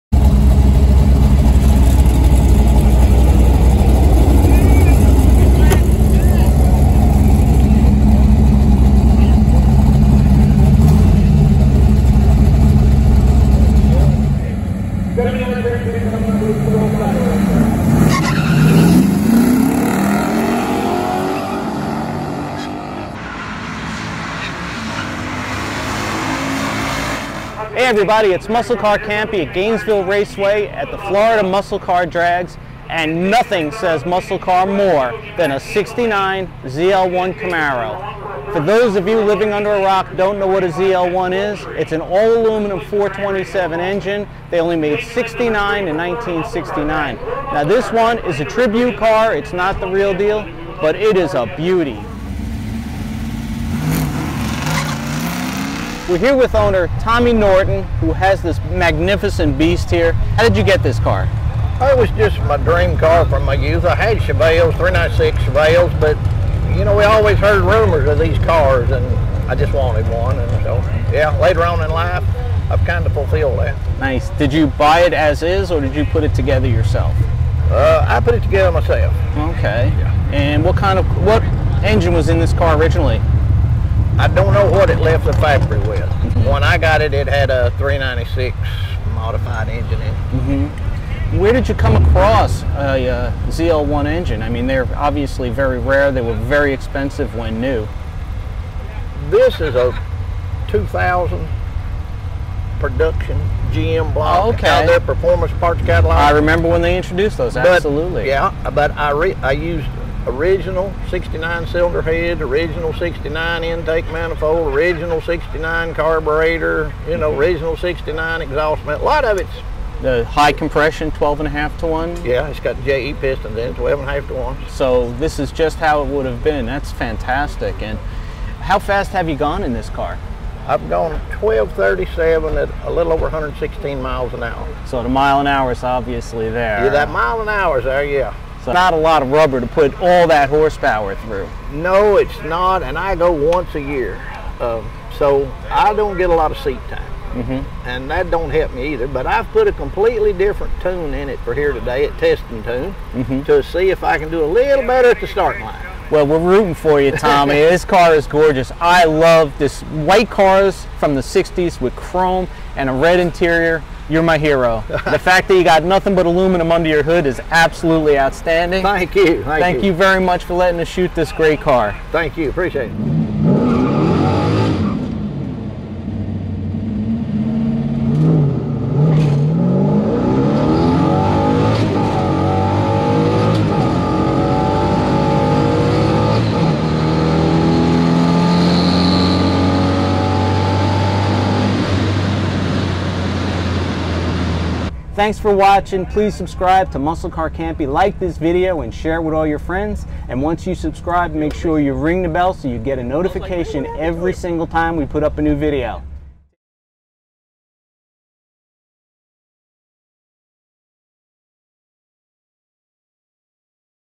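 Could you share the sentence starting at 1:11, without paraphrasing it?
Later on in life, I've kind of fulfilled that.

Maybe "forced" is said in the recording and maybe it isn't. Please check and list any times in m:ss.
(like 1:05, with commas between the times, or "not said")
not said.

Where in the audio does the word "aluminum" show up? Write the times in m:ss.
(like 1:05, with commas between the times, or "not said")
0:42, 2:46.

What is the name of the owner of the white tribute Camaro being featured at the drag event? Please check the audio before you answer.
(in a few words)
Tommy Norton.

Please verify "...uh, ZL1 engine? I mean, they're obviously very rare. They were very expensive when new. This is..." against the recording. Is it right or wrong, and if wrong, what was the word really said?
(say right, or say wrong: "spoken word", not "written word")
right.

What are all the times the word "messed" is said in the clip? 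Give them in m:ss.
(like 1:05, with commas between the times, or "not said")
not said.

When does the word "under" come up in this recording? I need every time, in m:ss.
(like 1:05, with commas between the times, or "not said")
0:39, 2:46.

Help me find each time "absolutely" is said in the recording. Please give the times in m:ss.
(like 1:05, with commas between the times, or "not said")
1:47, 2:47.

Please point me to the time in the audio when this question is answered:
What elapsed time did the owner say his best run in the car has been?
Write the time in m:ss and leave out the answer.
2:11.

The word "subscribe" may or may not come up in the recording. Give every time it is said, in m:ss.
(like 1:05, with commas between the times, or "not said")
3:16, 3:20.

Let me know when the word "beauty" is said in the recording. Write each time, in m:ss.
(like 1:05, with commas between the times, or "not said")
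0:51.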